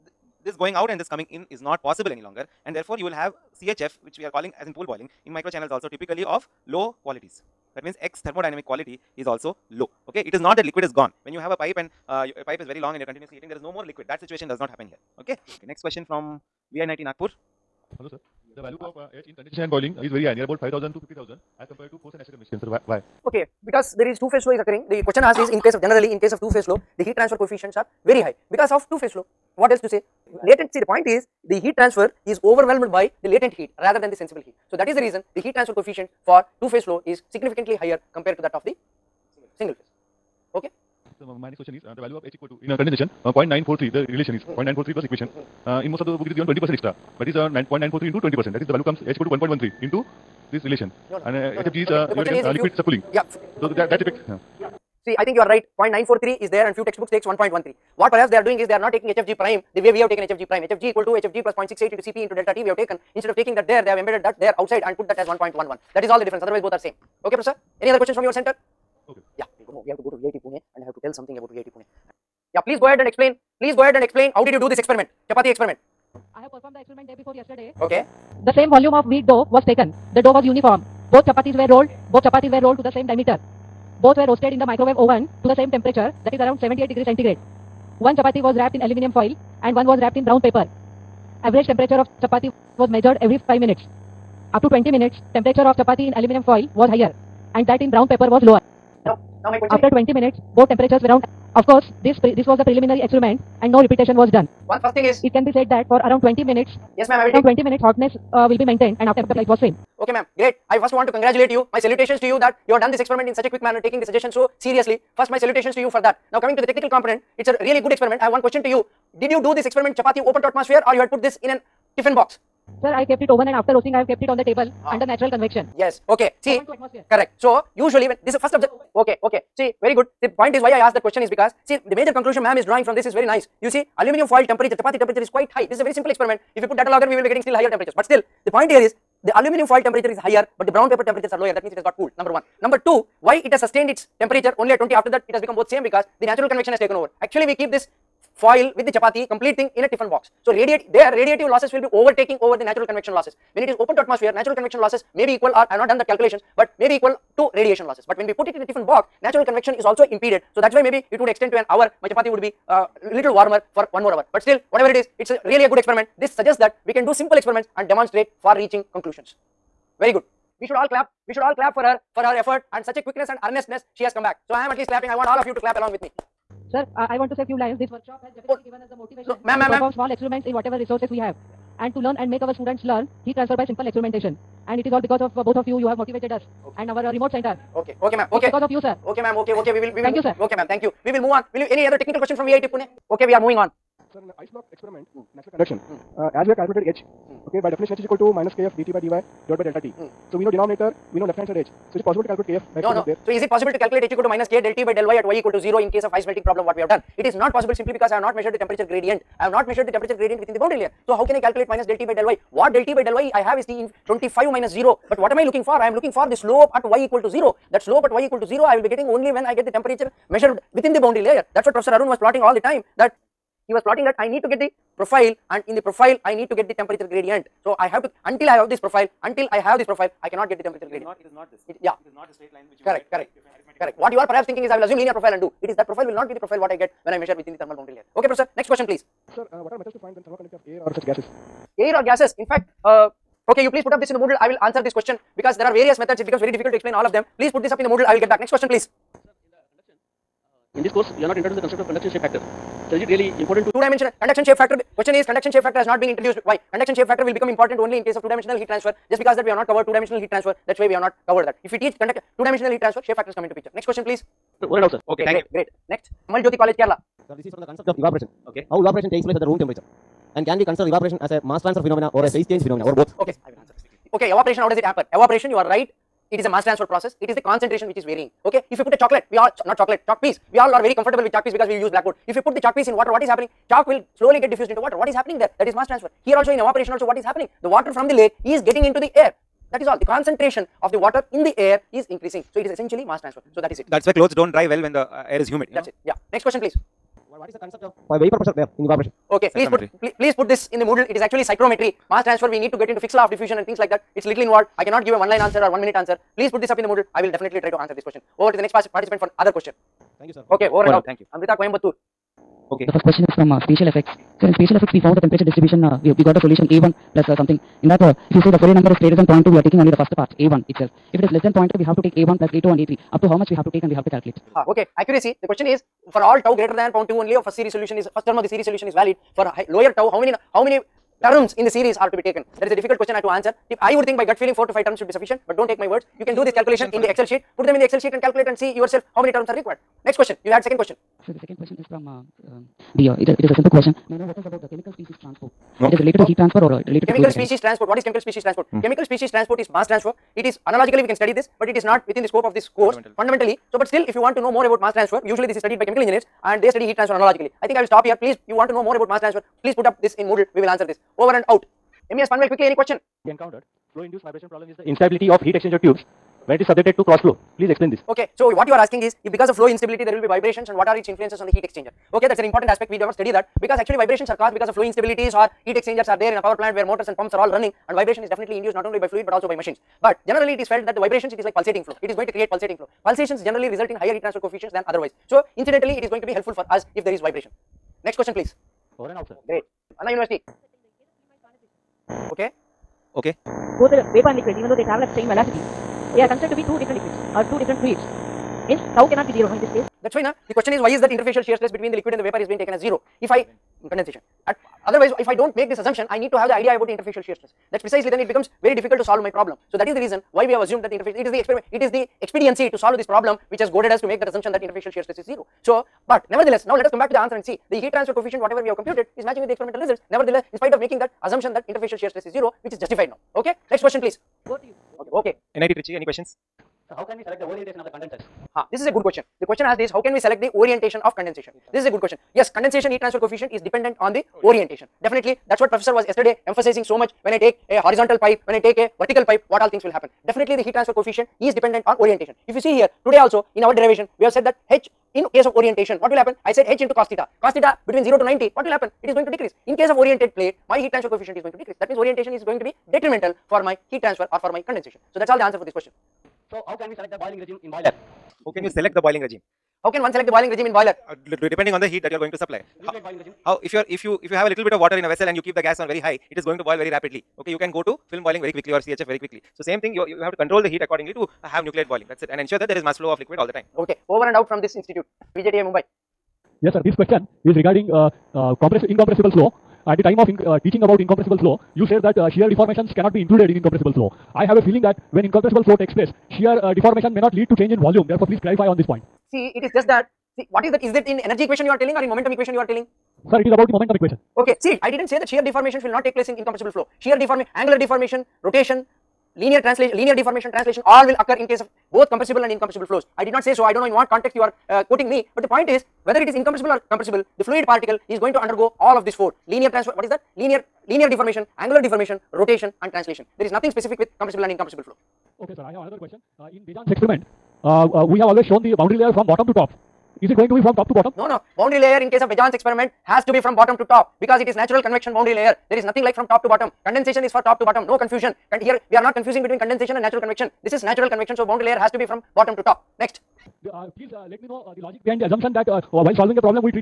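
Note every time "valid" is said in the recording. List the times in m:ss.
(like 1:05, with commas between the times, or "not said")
5:28.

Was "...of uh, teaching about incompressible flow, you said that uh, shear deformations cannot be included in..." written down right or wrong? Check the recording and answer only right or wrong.
right.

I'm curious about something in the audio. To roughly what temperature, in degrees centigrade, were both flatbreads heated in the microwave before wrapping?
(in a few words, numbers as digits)
78.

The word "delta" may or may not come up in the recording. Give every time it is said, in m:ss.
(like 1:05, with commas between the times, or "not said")
1:02, 3:19.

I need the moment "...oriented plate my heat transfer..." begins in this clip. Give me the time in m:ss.
7:29.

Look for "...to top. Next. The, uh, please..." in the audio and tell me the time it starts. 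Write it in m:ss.
8:52.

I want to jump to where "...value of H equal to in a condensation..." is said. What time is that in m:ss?
0:42.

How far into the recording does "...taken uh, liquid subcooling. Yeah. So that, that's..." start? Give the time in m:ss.
0:52.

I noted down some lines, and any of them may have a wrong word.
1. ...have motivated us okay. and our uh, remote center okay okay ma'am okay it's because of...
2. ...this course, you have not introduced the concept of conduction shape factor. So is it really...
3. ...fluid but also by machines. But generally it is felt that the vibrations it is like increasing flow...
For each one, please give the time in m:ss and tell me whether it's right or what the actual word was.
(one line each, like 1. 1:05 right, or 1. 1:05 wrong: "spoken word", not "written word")
1. 3:05 right
2. 4:10 right
3. 6:19 wrong: "pulsating", not "increasing".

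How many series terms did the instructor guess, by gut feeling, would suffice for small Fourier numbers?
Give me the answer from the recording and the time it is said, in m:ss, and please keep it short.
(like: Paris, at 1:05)
4 to 5, at 5:34.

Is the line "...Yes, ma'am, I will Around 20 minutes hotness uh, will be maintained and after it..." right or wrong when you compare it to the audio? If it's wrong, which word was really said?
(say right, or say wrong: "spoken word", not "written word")
right.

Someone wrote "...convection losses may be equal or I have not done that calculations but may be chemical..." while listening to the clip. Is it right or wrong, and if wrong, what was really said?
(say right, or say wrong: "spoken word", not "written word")
wrong: "equal", not "chemical".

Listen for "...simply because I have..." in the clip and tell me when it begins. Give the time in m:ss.
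3:27.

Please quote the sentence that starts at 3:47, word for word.
So, I have to until I have this profile until I have this profile I cannot get the temperature gradient.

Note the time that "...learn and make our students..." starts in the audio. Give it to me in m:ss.
3:02.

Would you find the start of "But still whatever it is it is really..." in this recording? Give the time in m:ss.
2:44.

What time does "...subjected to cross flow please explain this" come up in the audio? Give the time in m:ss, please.
6:06.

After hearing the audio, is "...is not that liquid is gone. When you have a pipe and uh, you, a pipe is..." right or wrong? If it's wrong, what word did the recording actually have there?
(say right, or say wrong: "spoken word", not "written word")
right.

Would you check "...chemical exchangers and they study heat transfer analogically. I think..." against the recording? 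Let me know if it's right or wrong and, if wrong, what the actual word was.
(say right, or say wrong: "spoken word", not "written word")
wrong: "engineers", not "exchangers".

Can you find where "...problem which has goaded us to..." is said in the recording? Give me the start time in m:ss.
6:53.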